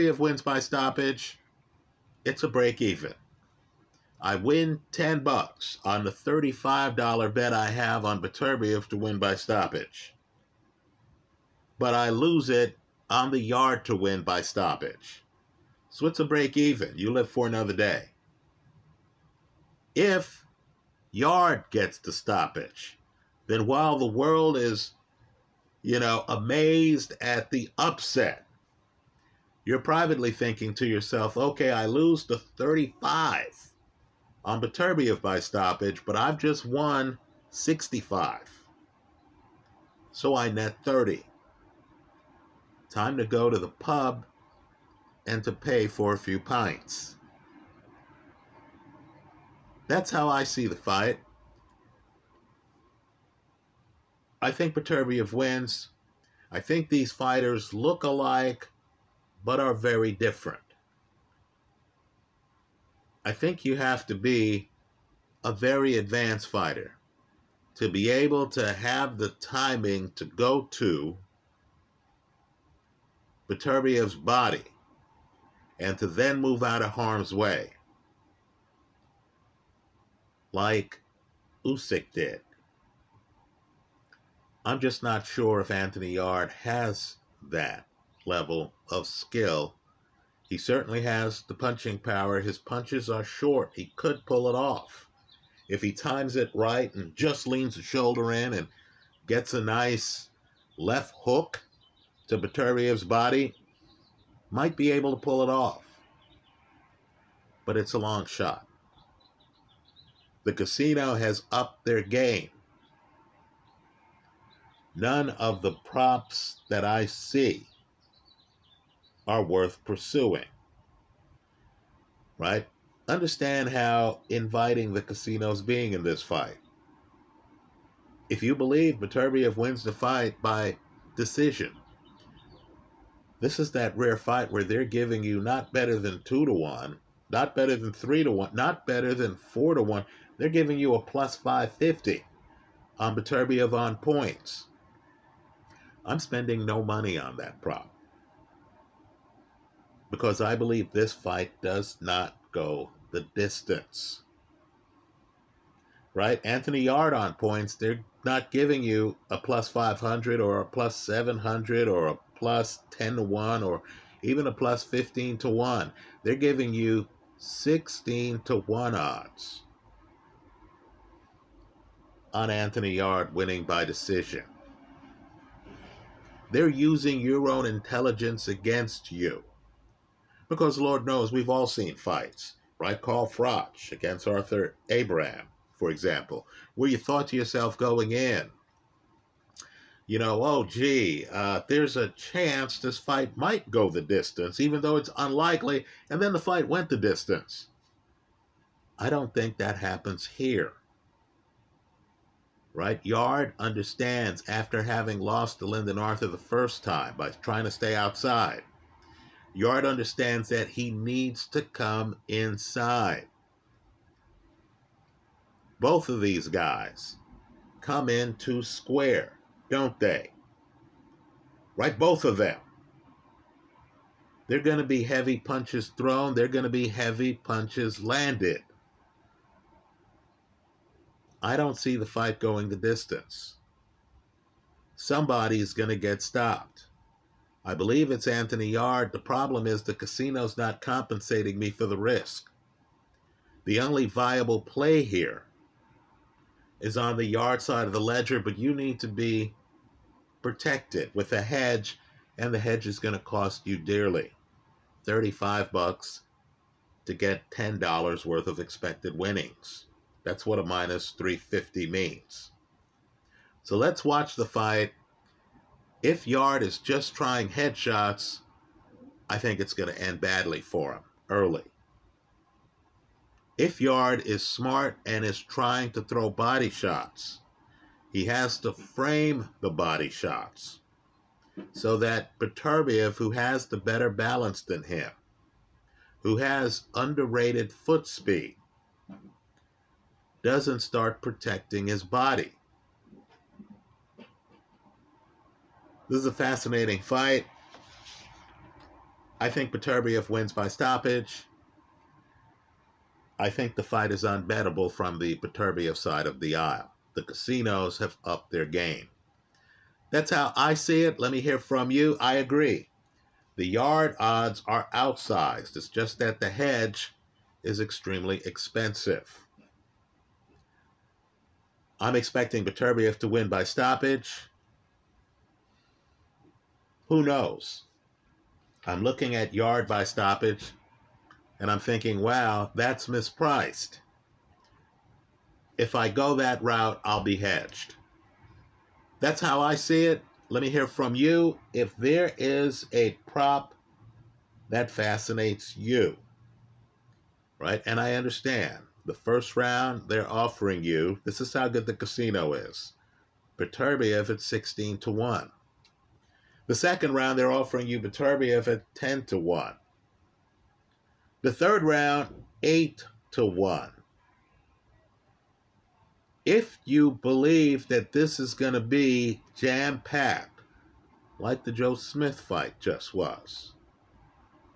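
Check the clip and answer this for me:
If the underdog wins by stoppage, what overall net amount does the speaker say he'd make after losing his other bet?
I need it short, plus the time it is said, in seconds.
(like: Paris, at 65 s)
30, at 40 s.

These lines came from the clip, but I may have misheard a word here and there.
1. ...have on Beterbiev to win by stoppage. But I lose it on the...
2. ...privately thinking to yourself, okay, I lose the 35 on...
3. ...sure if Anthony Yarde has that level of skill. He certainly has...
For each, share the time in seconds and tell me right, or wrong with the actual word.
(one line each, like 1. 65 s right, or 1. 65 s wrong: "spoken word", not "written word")
1. 7 s right
2. 29 s right
3. 85 s right.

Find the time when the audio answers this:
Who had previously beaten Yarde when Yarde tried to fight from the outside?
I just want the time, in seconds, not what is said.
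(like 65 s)
205 s.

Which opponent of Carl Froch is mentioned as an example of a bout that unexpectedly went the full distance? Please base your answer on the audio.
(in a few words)
Arthur Abraham.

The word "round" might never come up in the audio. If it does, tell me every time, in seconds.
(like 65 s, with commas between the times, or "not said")
349 s, 357 s, 361 s.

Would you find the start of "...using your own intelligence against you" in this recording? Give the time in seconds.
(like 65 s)
176 s.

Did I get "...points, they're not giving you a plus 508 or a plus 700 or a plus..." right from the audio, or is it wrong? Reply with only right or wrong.
wrong.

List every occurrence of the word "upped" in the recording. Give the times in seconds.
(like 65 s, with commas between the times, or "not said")
111 s, 308 s.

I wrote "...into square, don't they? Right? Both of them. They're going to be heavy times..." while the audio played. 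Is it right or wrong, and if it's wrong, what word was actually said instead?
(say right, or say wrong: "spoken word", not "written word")
wrong: "punches", not "times".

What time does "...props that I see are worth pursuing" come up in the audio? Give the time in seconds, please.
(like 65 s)
115 s.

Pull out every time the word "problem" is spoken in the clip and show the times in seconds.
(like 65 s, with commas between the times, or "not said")
239 s.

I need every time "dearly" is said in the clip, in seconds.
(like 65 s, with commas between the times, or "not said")
253 s.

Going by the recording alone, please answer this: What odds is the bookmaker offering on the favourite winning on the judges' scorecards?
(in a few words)
+550.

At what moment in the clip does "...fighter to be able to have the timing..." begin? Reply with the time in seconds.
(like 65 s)
66 s.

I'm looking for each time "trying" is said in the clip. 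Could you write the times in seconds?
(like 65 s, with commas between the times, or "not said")
207 s, 267 s, 275 s.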